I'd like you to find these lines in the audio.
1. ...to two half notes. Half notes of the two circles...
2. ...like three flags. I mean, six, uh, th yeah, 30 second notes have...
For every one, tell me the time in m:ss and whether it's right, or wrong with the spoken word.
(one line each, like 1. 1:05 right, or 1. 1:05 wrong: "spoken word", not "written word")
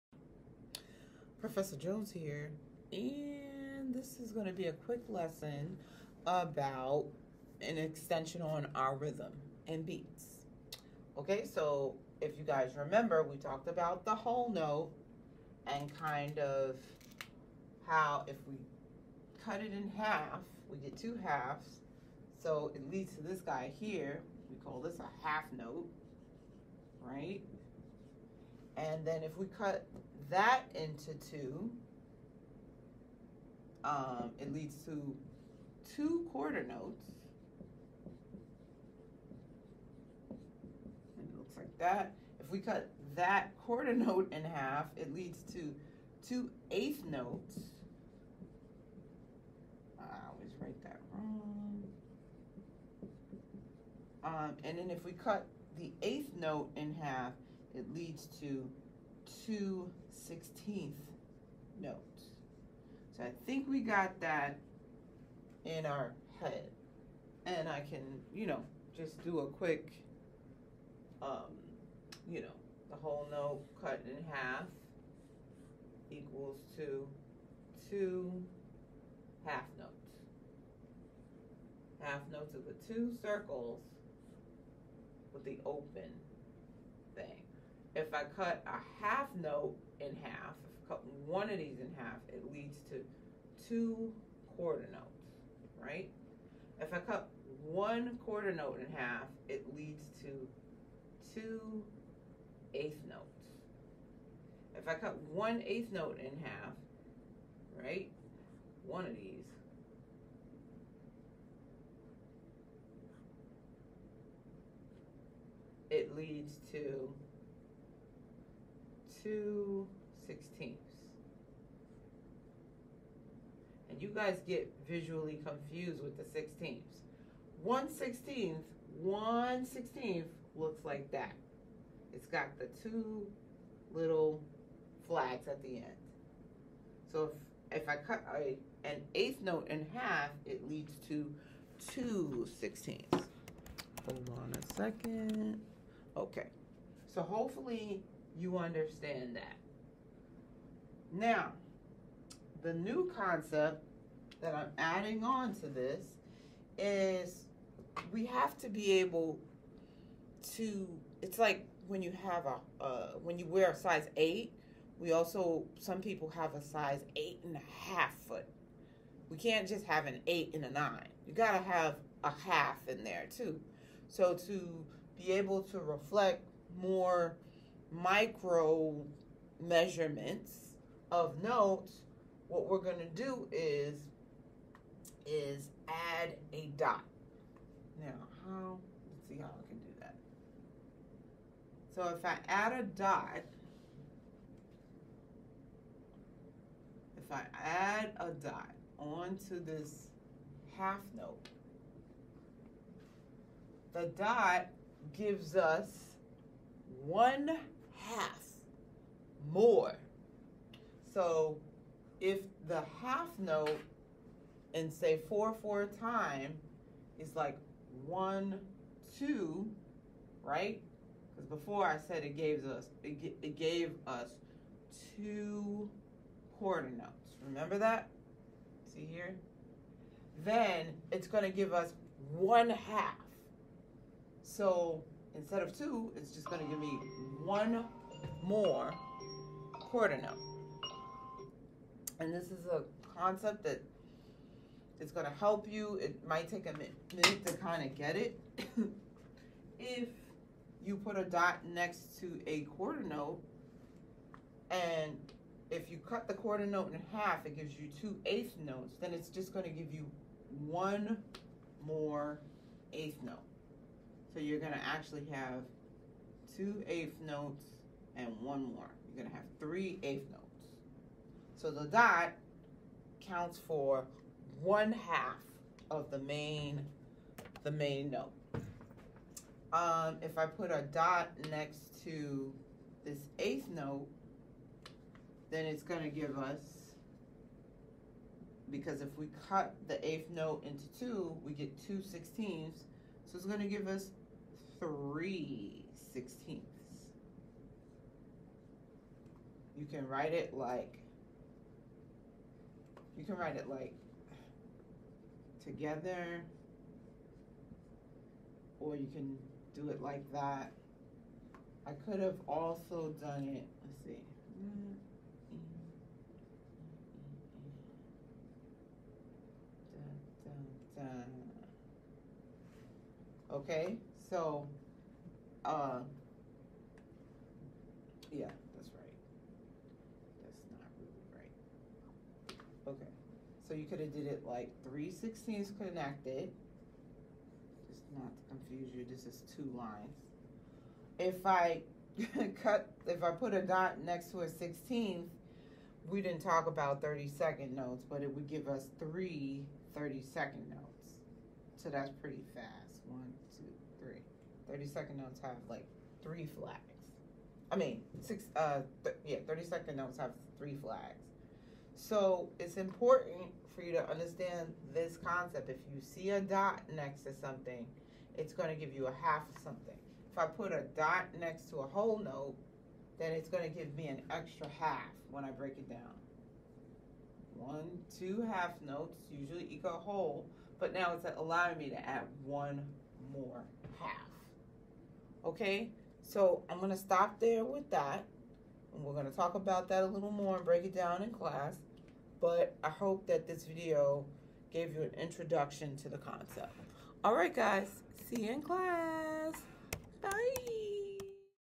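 1. 1:16 right
2. 5:55 right.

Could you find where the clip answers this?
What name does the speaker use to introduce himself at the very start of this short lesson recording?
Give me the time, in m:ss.
0:01.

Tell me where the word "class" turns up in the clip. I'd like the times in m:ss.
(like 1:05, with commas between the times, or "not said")
6:31, 6:38.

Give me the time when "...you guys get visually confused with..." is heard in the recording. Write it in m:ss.
2:04.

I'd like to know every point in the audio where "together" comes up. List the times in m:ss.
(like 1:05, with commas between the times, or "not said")
5:05.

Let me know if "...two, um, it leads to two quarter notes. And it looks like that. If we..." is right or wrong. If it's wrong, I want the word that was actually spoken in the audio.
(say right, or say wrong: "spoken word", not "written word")
right.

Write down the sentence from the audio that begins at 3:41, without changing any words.
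Because before I said it gave us, it, it gave us two quarter notes.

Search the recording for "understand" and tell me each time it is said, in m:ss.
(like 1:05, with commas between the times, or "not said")
2:28, 6:04.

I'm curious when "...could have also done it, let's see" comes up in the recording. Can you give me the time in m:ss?
5:12.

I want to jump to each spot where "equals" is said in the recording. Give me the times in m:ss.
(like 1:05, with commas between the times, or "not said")
1:16, 6:19.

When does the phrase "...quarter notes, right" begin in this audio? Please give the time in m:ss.
1:34.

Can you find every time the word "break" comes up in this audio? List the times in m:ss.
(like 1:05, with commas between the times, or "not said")
6:15, 6:30.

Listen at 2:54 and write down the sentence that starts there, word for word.
So to be able to reflect more micro measurements of notes, what we're going to do is is add a dot.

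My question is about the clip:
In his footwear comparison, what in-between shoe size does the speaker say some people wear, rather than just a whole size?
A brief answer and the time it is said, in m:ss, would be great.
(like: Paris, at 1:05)
eight and a half, at 2:46.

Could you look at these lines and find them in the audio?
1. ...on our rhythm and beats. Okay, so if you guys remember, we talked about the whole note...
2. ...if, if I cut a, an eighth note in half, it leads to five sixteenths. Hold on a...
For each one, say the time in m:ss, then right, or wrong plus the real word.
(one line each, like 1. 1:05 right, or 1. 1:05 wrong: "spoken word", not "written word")
1. 0:08 right
2. 2:17 wrong: "two", not "five".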